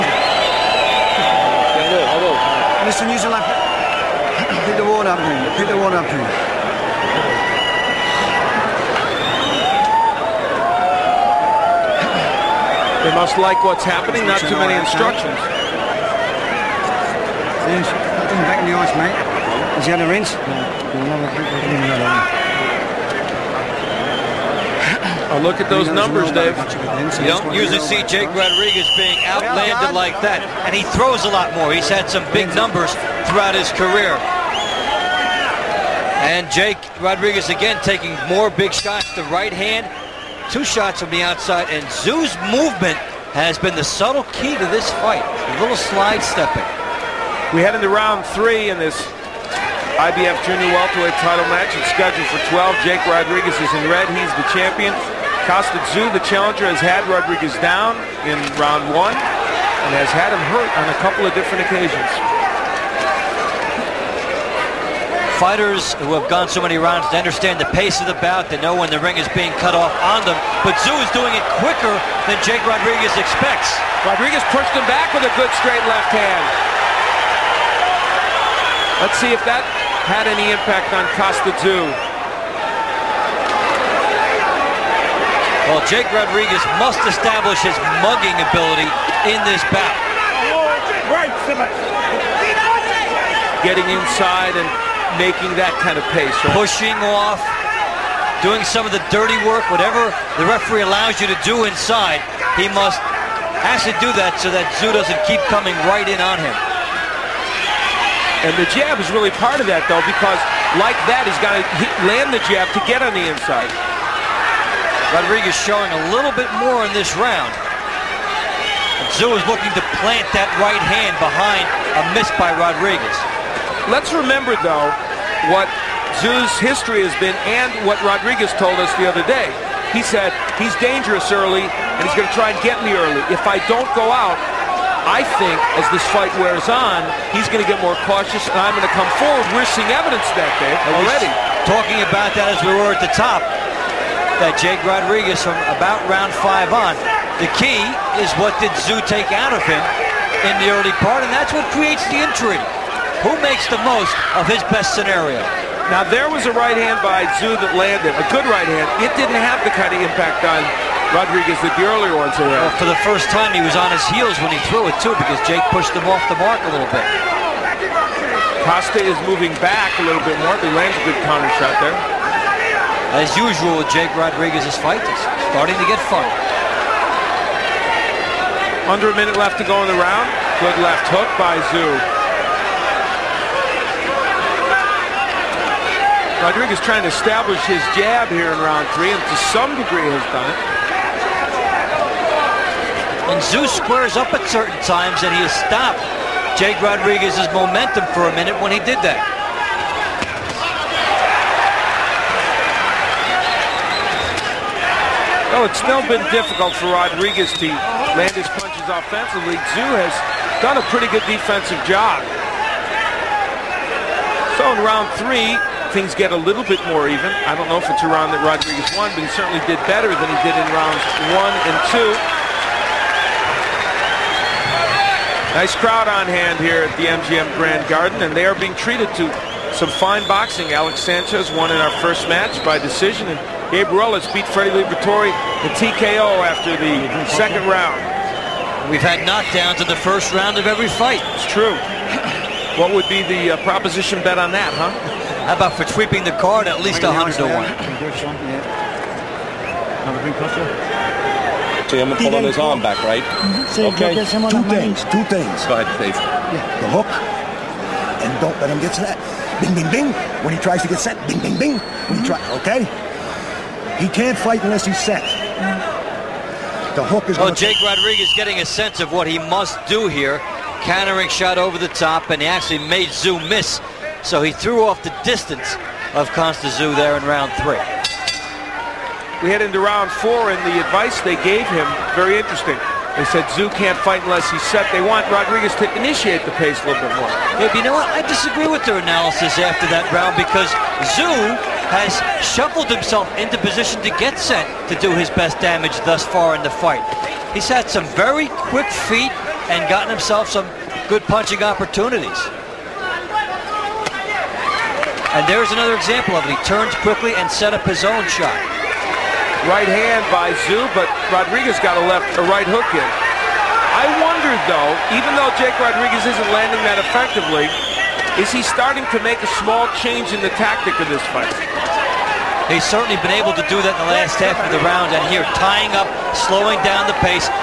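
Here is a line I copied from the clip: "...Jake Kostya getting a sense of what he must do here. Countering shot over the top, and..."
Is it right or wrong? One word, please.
wrong.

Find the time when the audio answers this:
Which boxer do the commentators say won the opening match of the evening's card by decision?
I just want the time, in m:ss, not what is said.
3:50.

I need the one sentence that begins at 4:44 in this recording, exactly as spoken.
They want Rodriguez to initiate the pace a little bit more.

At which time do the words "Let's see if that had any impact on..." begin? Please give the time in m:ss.
1:18.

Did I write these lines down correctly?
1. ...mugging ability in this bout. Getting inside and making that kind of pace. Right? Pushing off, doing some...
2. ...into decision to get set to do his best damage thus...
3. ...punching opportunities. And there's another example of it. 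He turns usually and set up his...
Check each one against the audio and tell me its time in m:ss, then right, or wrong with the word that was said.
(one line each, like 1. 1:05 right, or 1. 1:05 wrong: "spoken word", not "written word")
1. 1:28 right
2. 4:53 wrong: "position", not "decision"
3. 5:01 wrong: "quickly", not "usually".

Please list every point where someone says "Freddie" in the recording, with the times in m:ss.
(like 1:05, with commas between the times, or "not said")
3:54.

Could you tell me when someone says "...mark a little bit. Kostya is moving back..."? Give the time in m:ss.
2:46.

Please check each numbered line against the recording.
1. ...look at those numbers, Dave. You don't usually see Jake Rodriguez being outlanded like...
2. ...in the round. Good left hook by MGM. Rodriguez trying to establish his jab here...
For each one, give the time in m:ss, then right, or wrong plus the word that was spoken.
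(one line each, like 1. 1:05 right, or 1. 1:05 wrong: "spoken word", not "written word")
1. 0:25 right
2. 2:59 wrong: "Tszyu", not "MGM".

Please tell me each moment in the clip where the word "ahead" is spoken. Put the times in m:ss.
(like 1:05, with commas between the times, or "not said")
4:15.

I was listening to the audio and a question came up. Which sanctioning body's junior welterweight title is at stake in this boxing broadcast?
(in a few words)
IBF.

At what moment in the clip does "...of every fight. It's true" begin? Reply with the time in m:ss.
4:00.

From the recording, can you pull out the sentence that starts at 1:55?
Rodriguez showing a little bit more in this round.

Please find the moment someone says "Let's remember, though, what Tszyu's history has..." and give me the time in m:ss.
2:03.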